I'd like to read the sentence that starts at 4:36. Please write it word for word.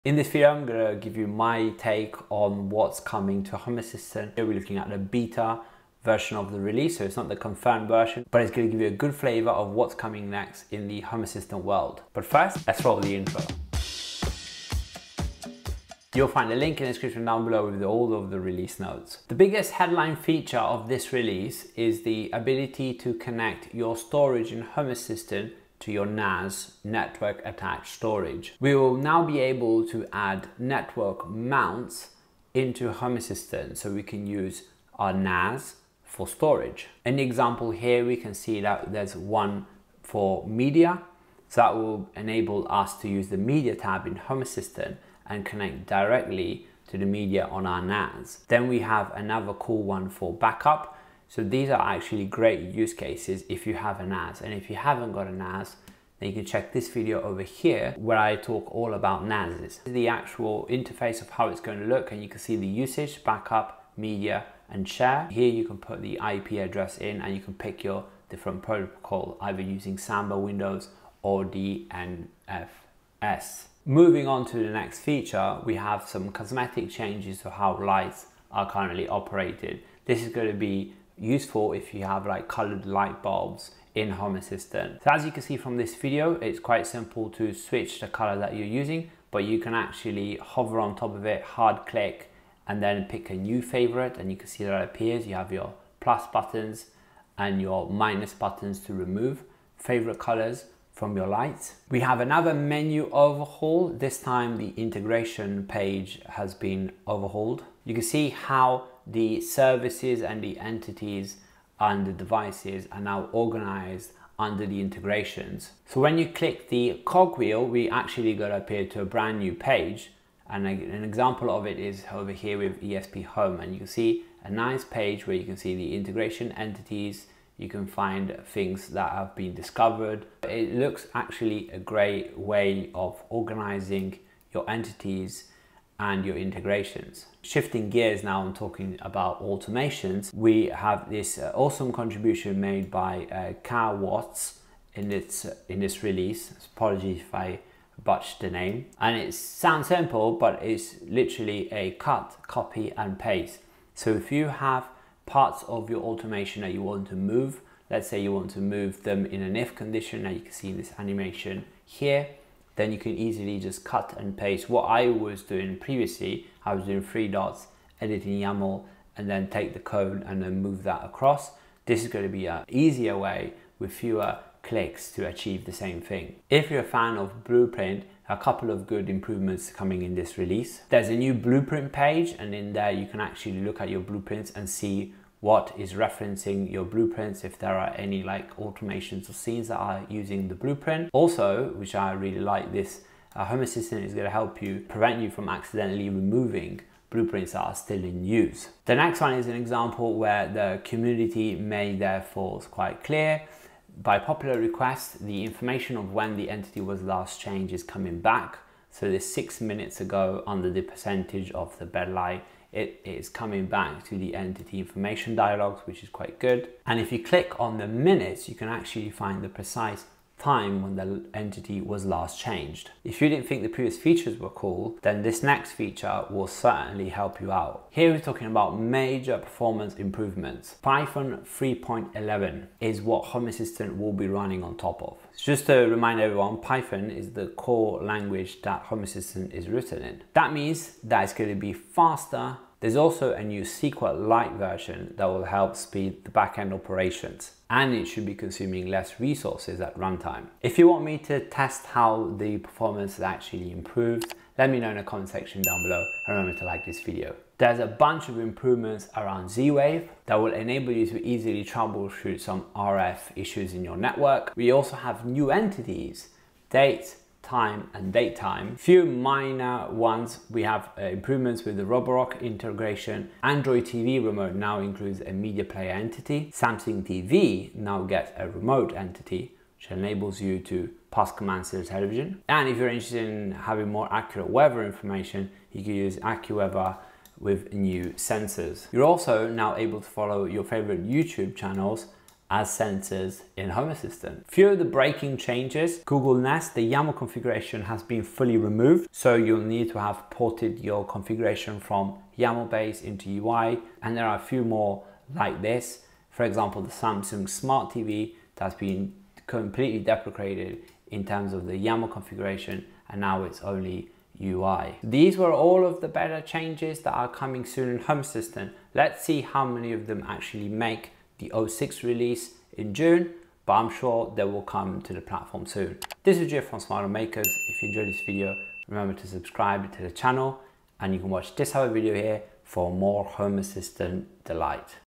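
Samsung TV now gets a remote entity, which enables you to pass commands to the television.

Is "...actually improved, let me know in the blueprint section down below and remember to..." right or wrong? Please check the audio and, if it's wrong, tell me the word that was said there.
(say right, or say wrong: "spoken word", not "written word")
wrong: "comment", not "blueprint".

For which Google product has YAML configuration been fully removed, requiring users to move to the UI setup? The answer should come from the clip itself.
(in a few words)
Google Nest.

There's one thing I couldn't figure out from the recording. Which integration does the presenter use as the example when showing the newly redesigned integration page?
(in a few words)
ESPHome.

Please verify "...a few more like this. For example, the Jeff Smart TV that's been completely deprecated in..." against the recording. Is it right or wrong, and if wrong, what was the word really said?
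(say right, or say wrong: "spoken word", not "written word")
wrong: "Samsung", not "Jeff".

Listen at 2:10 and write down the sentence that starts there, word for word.
It looks actually a great way of organizing your entities and your integrations.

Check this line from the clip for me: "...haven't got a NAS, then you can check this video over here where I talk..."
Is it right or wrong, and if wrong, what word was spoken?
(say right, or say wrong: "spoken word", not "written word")
right.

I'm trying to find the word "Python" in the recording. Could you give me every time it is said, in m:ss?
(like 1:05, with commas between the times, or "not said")
3:50, 3:56.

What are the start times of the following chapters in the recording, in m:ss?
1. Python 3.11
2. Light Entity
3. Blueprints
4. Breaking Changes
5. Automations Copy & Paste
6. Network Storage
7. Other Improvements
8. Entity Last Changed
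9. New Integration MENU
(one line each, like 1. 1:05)
1. 3:42
2. 1:31
3. 2:56
4. 4:57
5. 2:17
6. 0:28
7. 4:17
8. 3:18
9. 1:41.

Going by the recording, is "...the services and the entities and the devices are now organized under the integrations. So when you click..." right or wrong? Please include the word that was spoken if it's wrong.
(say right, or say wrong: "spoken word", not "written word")
right.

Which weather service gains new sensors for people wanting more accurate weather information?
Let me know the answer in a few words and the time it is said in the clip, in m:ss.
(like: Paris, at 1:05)
AccuWeather, at 4:46.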